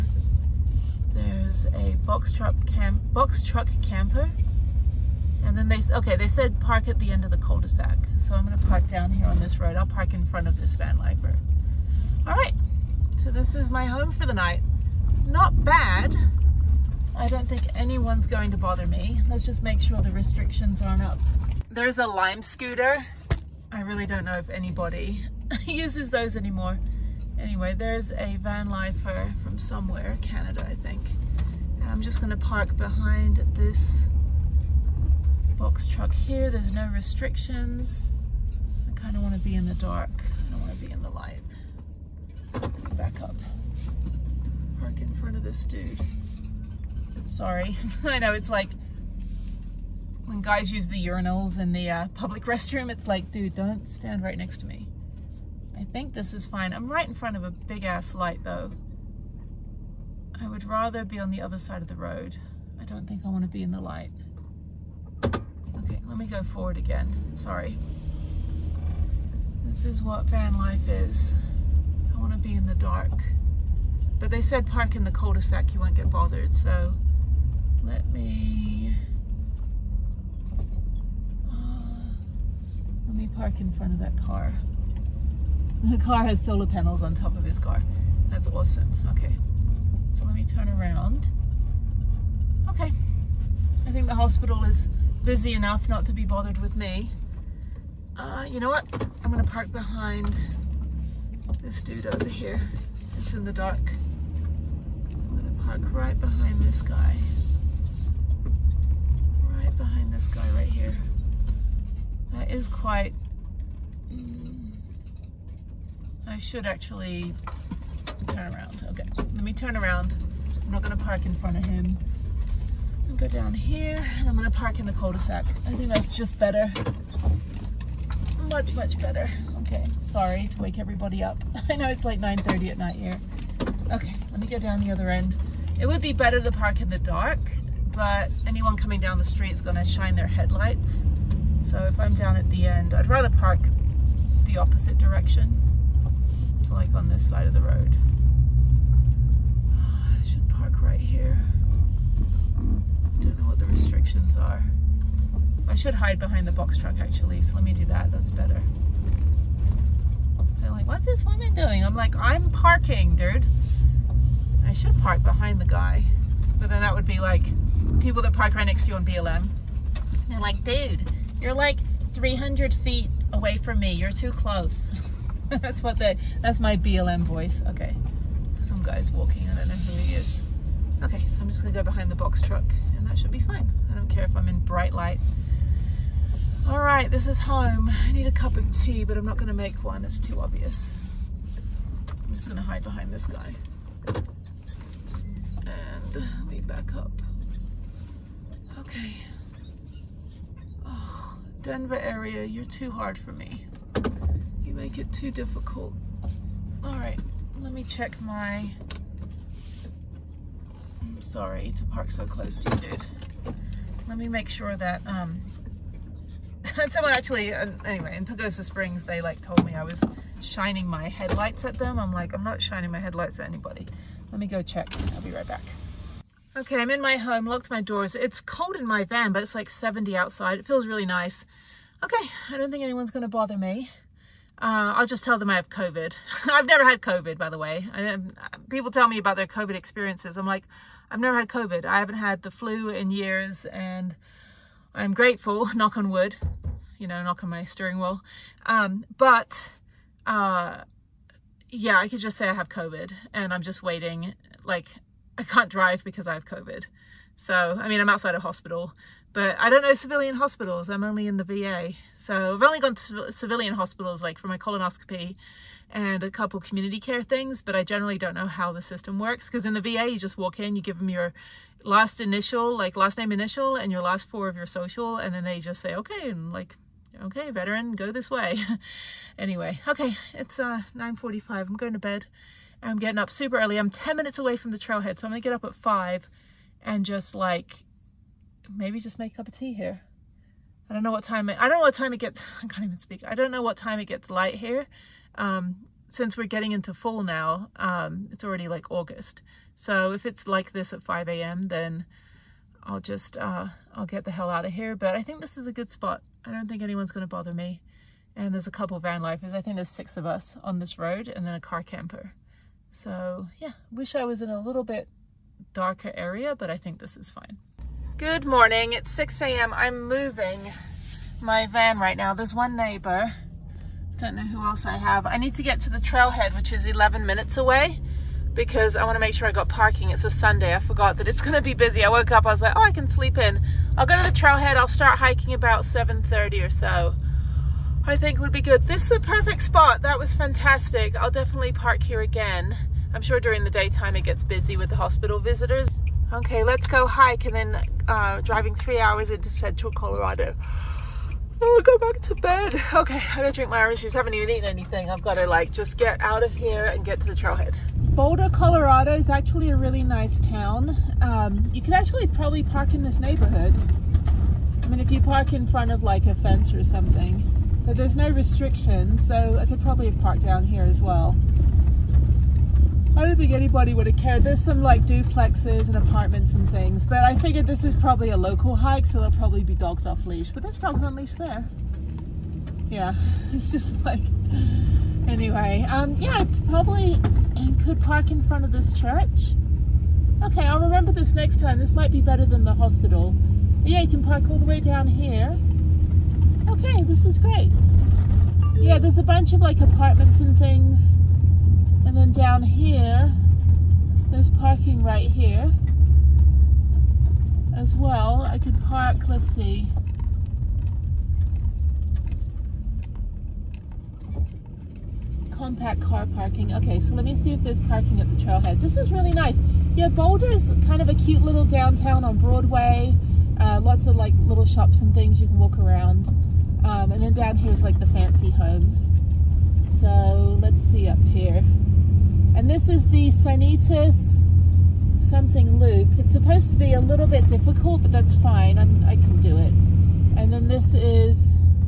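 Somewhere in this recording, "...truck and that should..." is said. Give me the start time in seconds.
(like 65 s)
182 s.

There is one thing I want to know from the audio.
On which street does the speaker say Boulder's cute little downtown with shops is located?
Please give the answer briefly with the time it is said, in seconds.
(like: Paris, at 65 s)
Broadway, at 422 s.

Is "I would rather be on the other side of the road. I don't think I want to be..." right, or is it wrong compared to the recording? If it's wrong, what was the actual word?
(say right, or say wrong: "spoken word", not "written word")
right.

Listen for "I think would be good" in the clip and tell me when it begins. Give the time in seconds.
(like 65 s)
338 s.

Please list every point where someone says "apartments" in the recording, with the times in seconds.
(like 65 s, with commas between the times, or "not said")
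375 s, 399 s.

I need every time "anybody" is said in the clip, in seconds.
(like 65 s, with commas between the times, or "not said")
24 s, 223 s, 373 s.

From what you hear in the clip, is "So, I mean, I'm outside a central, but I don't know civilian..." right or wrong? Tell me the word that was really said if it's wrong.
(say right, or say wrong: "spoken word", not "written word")
wrong: "hospital", not "central".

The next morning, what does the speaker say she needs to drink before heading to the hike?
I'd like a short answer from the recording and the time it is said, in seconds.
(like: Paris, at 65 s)
Orange juice, at 353 s.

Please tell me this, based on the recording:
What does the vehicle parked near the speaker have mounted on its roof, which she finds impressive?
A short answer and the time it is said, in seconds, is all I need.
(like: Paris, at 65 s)
Solar panels, at 86 s.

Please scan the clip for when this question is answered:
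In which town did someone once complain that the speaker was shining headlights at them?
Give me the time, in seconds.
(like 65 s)
218 s.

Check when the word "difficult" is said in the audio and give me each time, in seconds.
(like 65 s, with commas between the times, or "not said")
205 s, 437 s.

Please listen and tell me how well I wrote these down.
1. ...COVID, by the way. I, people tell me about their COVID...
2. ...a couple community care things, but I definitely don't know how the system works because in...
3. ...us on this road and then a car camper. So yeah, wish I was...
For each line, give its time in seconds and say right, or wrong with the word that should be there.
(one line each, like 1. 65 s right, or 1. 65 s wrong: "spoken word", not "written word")
1. 236 s right
2. 266 s wrong: "generally", not "definitely"
3. 310 s right.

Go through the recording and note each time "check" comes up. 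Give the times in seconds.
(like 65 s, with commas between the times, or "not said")
207 s, 224 s.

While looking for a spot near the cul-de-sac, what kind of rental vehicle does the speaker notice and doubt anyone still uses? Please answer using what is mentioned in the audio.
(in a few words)
Lime scooter.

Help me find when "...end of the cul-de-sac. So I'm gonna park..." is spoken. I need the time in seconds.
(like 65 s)
7 s.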